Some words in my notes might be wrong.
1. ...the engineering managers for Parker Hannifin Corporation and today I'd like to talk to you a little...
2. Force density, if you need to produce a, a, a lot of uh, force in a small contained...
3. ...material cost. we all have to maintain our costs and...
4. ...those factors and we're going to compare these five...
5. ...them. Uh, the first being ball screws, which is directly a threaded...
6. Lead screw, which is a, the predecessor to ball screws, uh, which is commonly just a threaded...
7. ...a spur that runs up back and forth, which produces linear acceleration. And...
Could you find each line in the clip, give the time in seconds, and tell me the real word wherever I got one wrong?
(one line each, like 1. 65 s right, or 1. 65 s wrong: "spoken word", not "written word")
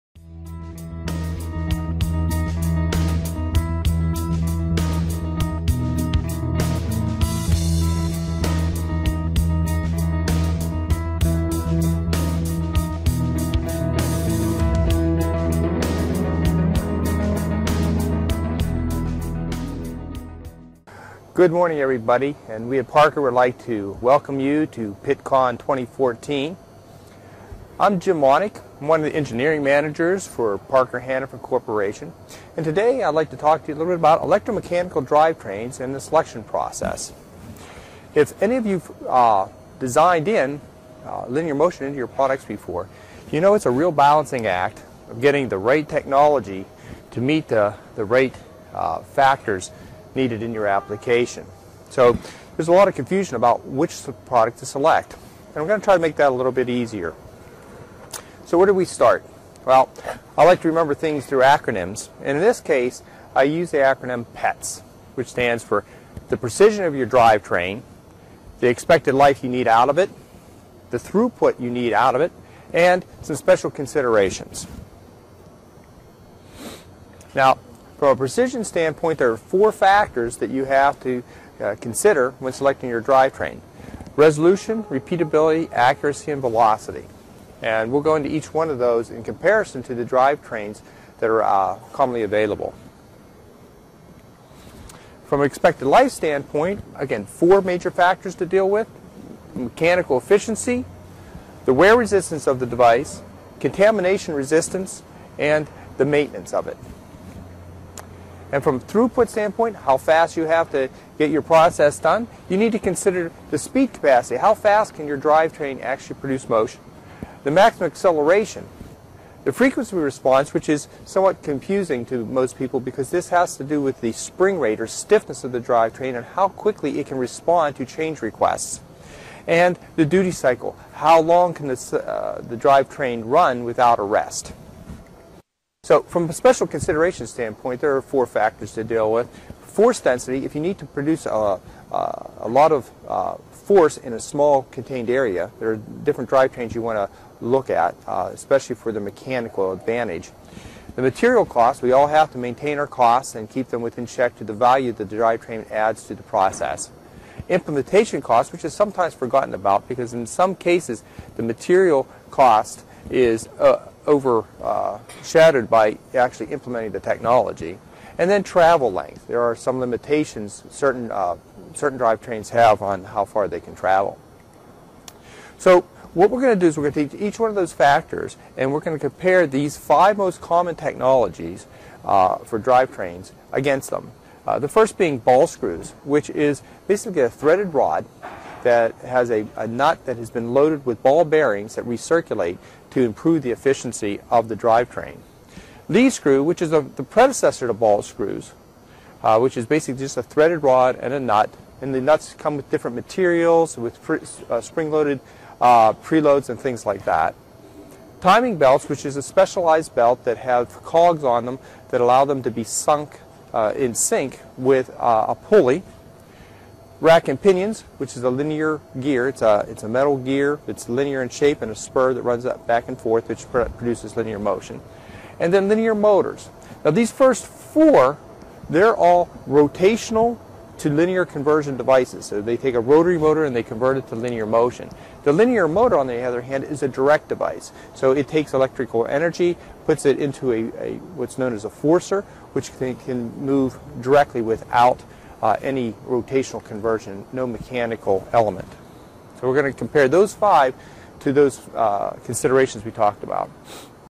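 1. 29 s right
2. 139 s right
3. 151 s right
4. 177 s right
5. 183 s wrong: "basically", not "directly"
6. 195 s wrong: "basically", not "commonly"
7. 221 s wrong: "motion", not "acceleration".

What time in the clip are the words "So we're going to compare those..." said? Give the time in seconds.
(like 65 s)
249 s.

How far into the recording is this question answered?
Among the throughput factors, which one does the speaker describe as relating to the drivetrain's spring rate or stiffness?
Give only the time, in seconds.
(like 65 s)
119 s.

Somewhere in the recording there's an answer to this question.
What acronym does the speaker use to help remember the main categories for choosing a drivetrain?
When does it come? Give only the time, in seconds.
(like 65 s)
64 s.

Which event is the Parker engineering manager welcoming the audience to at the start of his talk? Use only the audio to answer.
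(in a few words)
Pittcon 2014.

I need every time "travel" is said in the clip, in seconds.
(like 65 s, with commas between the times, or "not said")
168 s, 173 s.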